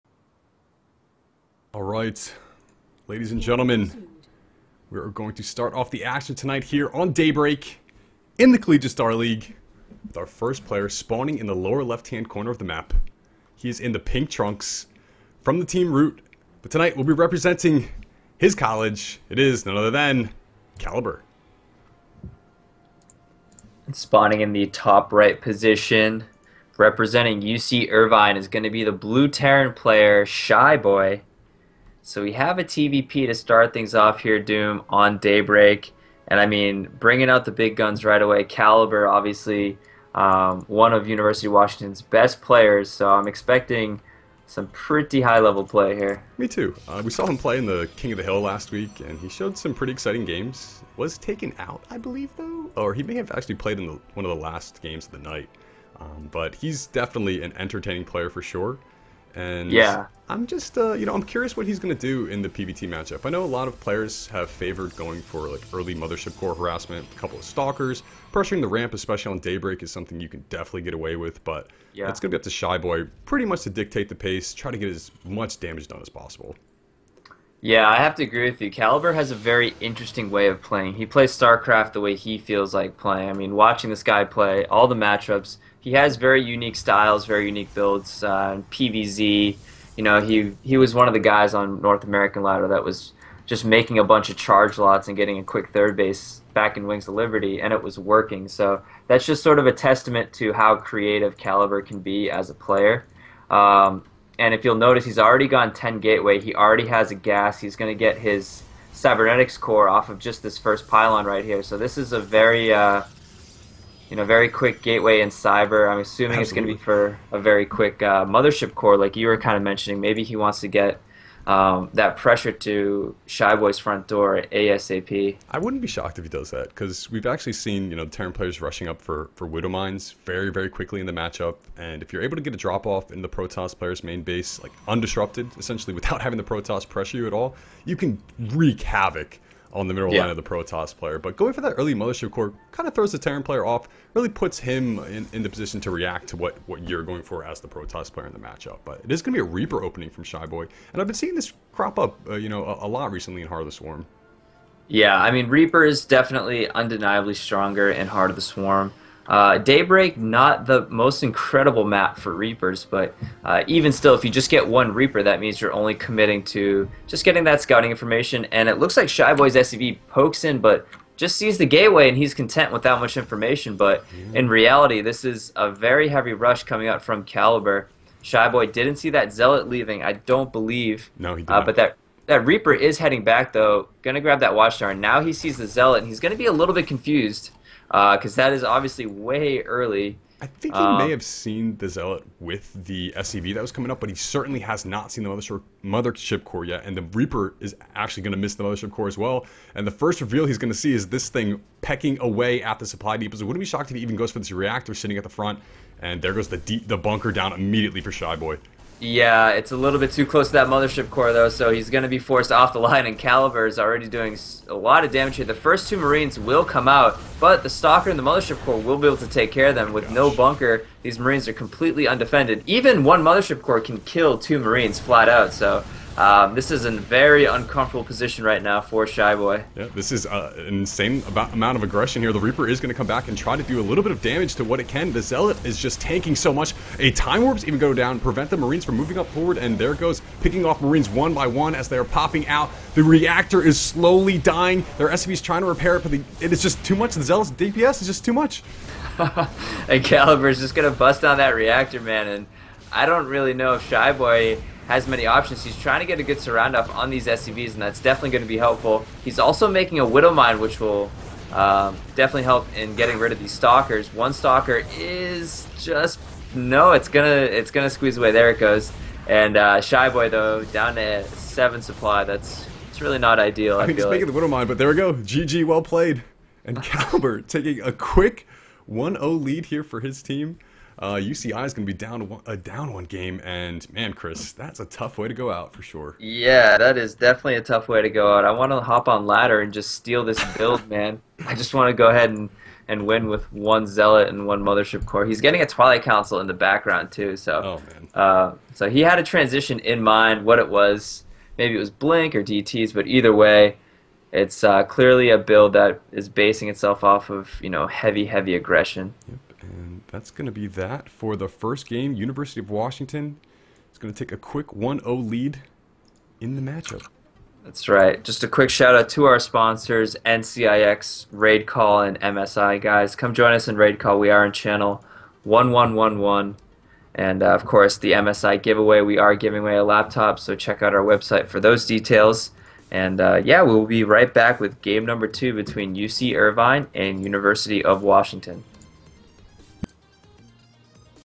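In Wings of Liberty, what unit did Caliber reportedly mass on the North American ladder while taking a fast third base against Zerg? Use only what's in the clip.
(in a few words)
Chargelots.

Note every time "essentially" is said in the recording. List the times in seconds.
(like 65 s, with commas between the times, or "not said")
135 s.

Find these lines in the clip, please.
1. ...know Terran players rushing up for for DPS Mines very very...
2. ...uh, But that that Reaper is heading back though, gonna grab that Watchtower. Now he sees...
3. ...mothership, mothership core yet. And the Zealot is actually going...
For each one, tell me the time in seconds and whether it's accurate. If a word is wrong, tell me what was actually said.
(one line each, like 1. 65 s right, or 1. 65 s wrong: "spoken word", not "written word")
1. 127 s wrong: "Widow", not "DPS"
2. 181 s right
3. 195 s wrong: "Reaper", not "Zealot".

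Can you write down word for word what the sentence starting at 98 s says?
So that's just sort of a testament to how creative Caliber can be as a player.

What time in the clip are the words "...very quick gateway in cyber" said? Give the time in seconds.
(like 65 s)
114 s.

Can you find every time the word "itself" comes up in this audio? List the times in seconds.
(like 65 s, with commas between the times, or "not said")
306 s.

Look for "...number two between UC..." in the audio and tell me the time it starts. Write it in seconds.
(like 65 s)
335 s.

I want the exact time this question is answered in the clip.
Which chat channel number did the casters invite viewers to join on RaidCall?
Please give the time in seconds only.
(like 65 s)
325 s.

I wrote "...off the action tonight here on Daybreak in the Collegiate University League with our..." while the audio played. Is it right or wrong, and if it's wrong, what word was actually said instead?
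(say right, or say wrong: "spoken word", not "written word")
wrong: "Star", not "University".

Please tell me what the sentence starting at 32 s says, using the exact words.
So we have a TVP to start things off here, Doom, on Daybreak.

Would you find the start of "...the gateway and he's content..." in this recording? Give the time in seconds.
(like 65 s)
171 s.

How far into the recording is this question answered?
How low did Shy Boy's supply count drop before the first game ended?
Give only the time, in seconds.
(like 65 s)
271 s.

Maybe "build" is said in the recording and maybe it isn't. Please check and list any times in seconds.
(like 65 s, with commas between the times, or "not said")
87 s, 290 s, 305 s.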